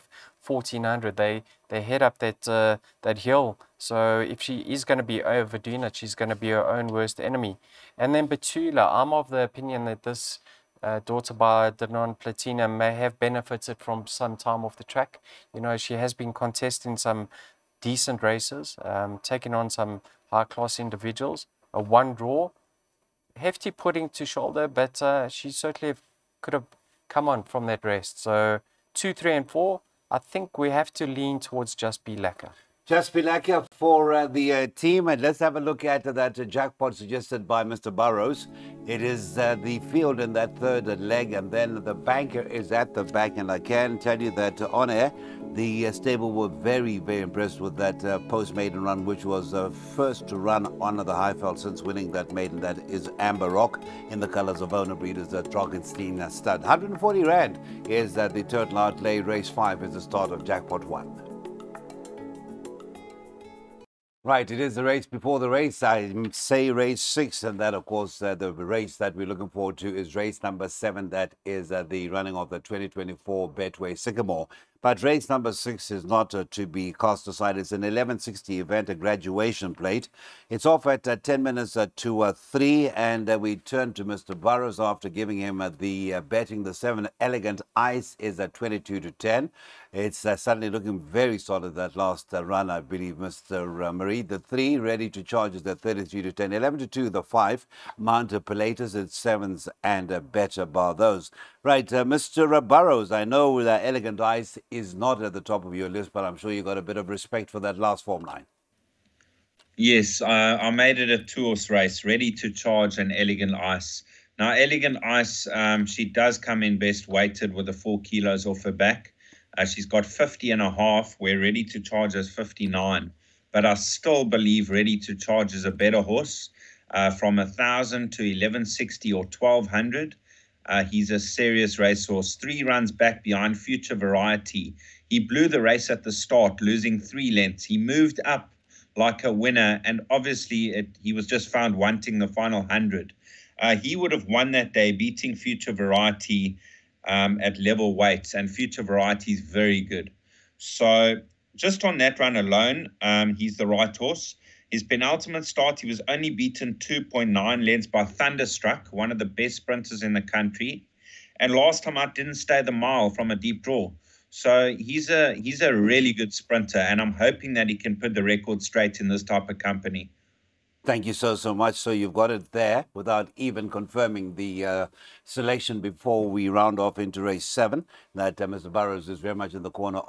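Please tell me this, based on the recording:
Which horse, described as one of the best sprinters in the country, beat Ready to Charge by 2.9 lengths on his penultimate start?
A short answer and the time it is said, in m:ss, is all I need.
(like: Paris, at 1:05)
Thunderstruck, at 2:38.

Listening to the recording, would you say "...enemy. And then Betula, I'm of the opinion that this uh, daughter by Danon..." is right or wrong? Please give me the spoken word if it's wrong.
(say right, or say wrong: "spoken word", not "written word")
right.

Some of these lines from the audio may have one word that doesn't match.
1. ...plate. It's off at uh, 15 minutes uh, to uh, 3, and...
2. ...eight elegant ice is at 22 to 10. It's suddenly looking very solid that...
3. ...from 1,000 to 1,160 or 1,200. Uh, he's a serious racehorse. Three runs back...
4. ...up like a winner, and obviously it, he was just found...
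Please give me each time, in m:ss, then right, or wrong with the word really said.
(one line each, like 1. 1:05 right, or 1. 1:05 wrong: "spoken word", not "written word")
1. 1:19 wrong: "10", not "15"
2. 1:26 wrong: "seven", not "eight"
3. 2:07 right
4. 2:18 right.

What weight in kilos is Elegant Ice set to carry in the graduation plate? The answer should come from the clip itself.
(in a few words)
50.5.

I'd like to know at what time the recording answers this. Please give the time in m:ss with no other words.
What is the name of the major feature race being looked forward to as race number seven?
1:12.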